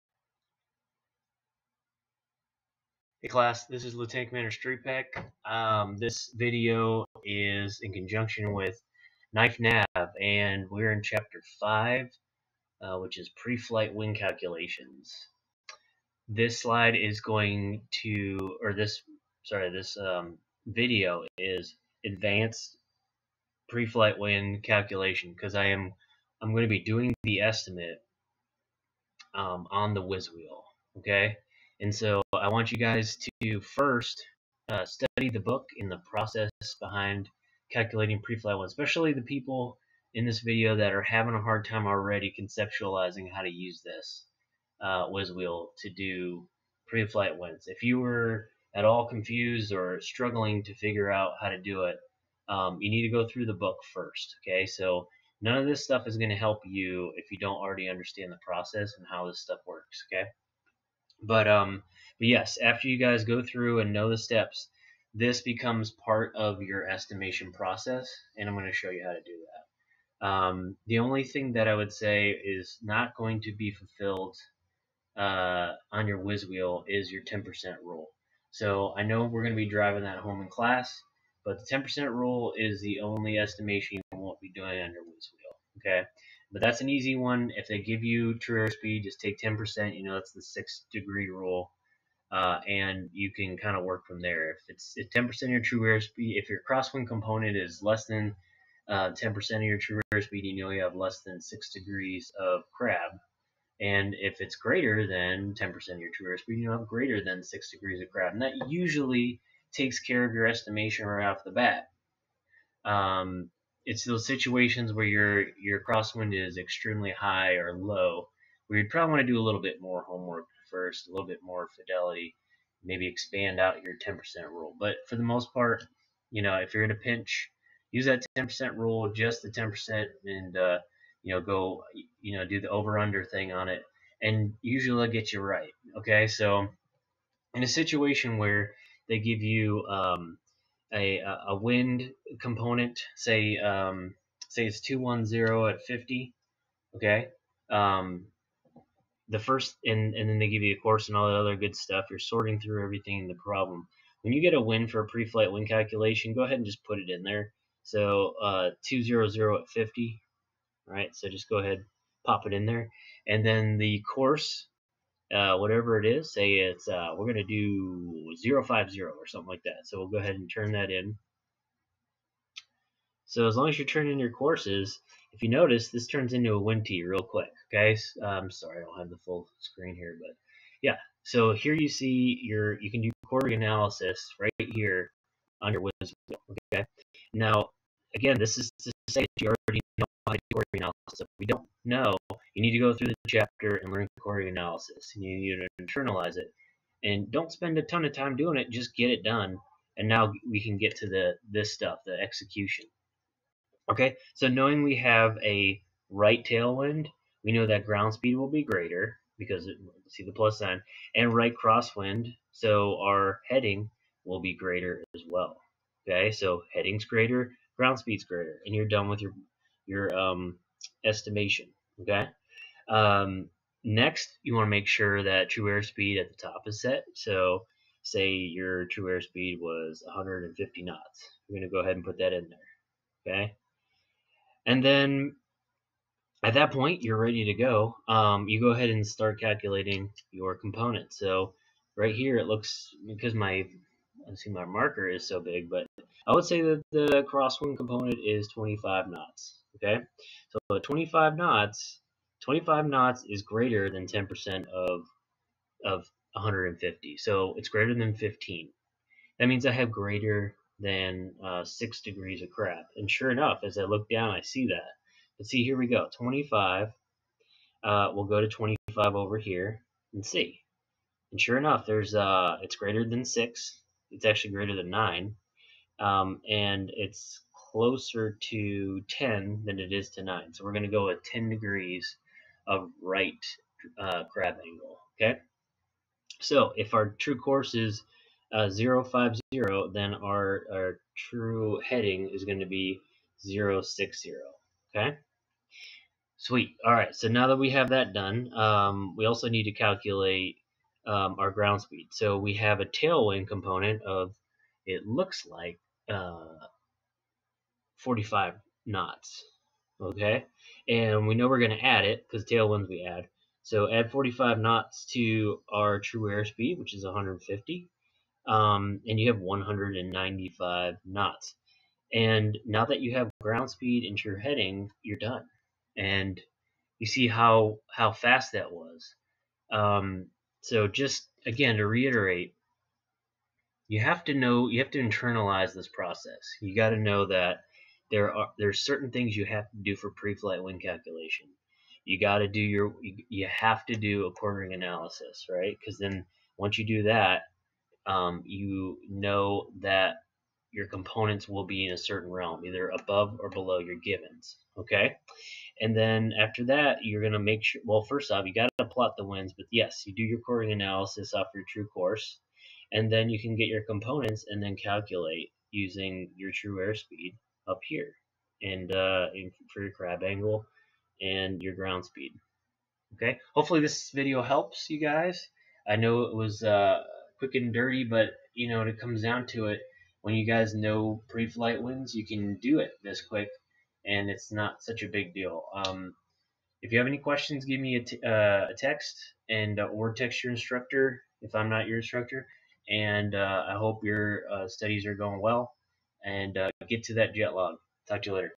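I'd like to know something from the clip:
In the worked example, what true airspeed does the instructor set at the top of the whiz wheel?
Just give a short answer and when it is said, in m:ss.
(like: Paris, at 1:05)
150 knots, at 3:50.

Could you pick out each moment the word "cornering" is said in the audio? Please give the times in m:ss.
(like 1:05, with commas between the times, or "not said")
5:44, 6:00.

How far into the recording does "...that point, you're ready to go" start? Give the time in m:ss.
3:56.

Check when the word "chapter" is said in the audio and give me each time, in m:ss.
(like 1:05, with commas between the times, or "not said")
0:11, 3:13.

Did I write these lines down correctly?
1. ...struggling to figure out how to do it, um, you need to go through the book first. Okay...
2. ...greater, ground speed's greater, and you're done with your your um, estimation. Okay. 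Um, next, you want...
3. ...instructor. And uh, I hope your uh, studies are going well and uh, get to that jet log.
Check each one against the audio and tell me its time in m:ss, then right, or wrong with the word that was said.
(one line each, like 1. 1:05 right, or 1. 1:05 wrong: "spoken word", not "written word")
1. 0:50 right
2. 3:37 right
3. 6:31 right.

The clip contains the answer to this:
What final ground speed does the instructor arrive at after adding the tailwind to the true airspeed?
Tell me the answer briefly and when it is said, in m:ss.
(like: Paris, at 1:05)
195 knots, at 5:19.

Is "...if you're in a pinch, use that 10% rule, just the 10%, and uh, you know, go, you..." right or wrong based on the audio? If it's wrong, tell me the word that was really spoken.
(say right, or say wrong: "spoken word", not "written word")
right.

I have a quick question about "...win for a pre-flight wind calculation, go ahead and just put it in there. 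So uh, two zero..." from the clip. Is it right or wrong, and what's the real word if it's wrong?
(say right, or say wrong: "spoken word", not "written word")
right.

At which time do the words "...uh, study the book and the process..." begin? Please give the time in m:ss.
0:34.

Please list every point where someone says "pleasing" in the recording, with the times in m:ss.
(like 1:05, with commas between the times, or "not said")
not said.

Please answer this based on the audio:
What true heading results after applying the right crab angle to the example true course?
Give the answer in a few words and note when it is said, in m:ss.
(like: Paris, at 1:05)
060, at 4:53.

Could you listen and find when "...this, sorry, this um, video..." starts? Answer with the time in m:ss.
0:18.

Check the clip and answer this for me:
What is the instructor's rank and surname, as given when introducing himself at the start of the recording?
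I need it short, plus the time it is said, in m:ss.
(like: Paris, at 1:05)
Lieutenant Commander Strupek, at 0:03.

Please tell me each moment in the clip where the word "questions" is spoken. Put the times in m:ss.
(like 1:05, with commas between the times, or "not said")
6:27.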